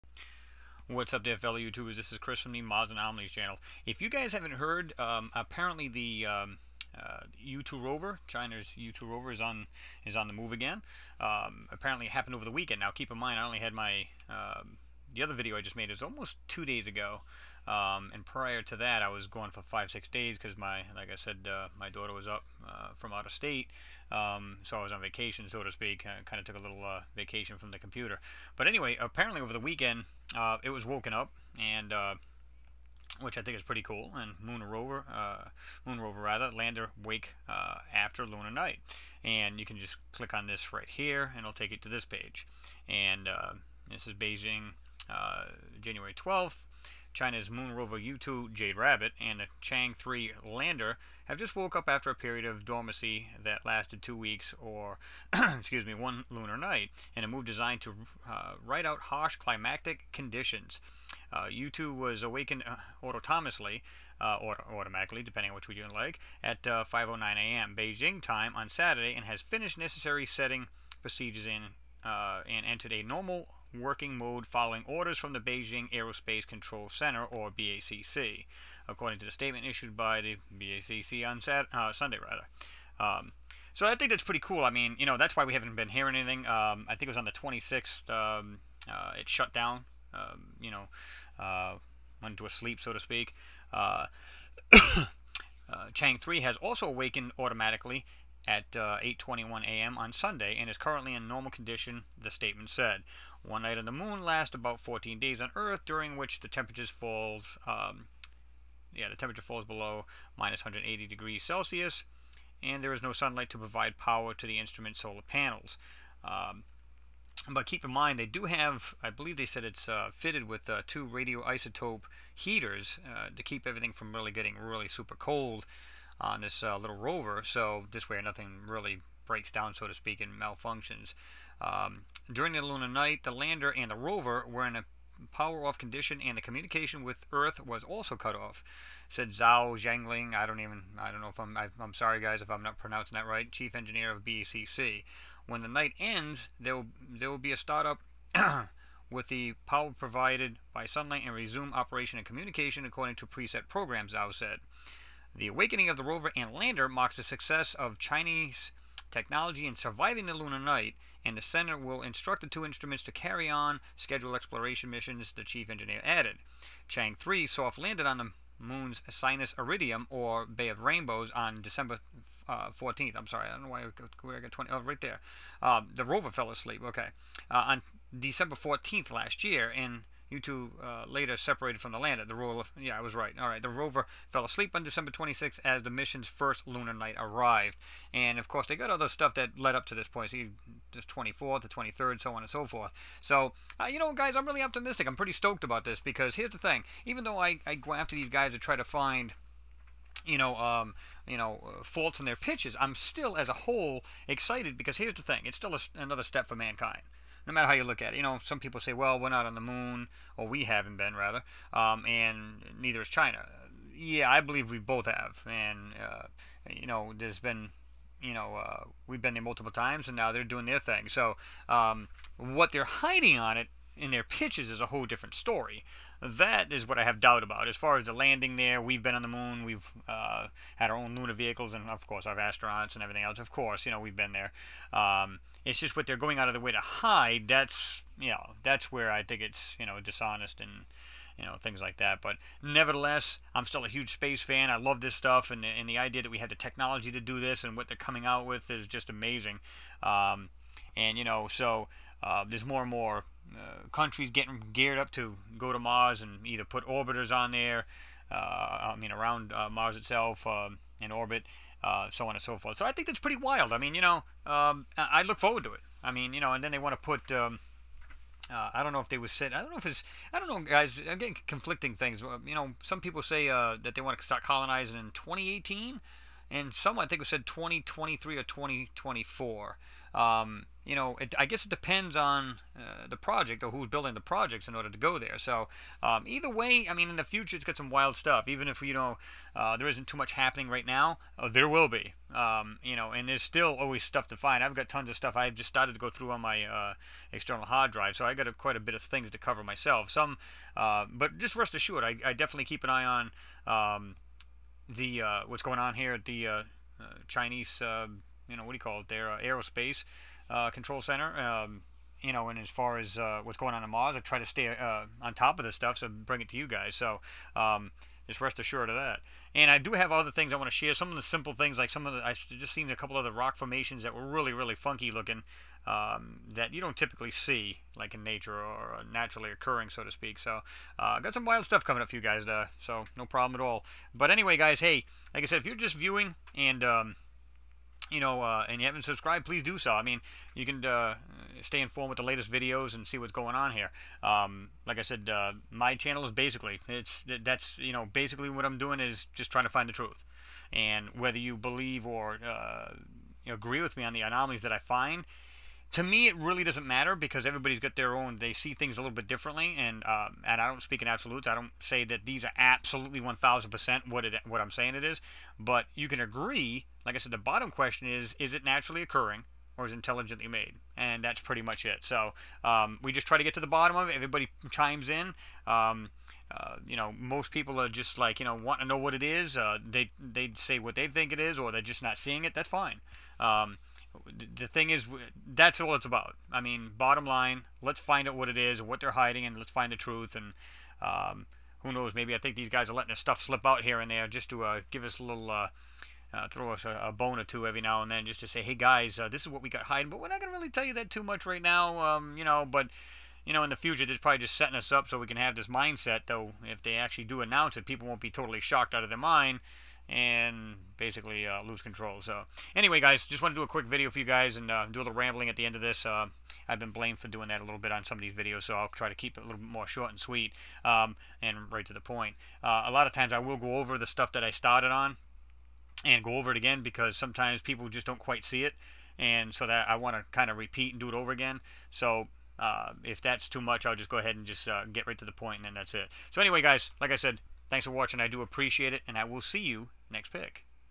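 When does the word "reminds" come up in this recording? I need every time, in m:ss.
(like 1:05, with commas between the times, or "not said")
not said.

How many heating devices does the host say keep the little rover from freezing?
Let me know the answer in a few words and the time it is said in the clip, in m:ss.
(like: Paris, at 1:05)
2 radioisotope heaters, at 2:00.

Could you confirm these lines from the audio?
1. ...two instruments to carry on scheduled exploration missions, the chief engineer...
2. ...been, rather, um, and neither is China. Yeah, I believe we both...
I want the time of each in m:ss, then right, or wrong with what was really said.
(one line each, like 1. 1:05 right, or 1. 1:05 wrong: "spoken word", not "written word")
1. 2:42 right
2. 3:30 right.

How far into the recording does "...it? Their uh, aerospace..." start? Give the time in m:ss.
5:09.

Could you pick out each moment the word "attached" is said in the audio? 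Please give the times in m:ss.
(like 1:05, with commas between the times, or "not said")
not said.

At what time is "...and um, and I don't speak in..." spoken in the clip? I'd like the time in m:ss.
5:59.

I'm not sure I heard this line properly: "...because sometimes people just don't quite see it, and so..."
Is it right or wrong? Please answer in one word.
right.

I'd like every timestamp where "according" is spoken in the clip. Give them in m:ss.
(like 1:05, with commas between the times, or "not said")
1:18, 2:32.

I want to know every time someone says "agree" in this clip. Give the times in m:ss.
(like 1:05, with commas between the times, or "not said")
5:53, 6:06.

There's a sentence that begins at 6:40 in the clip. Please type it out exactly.
But we're not gonna really tell you that too much right now, um, you know.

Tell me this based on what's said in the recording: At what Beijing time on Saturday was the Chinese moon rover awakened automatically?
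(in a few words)
5:09 a.m.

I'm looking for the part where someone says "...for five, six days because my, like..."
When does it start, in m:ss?
0:19.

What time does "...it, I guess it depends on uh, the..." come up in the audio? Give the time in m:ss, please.
4:41.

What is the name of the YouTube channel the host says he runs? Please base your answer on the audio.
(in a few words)
Mars Anomalies.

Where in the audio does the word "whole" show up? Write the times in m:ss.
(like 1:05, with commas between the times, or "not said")
3:23, 3:44.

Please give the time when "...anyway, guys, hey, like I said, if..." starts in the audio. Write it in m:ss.
5:34.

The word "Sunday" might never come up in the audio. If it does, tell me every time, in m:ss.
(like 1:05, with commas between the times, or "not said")
1:21, 1:40.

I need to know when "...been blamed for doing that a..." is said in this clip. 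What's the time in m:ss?
6:56.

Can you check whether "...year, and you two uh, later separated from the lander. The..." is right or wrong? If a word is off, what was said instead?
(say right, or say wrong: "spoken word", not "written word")
right.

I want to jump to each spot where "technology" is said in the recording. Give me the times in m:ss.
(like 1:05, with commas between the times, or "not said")
2:39, 4:06.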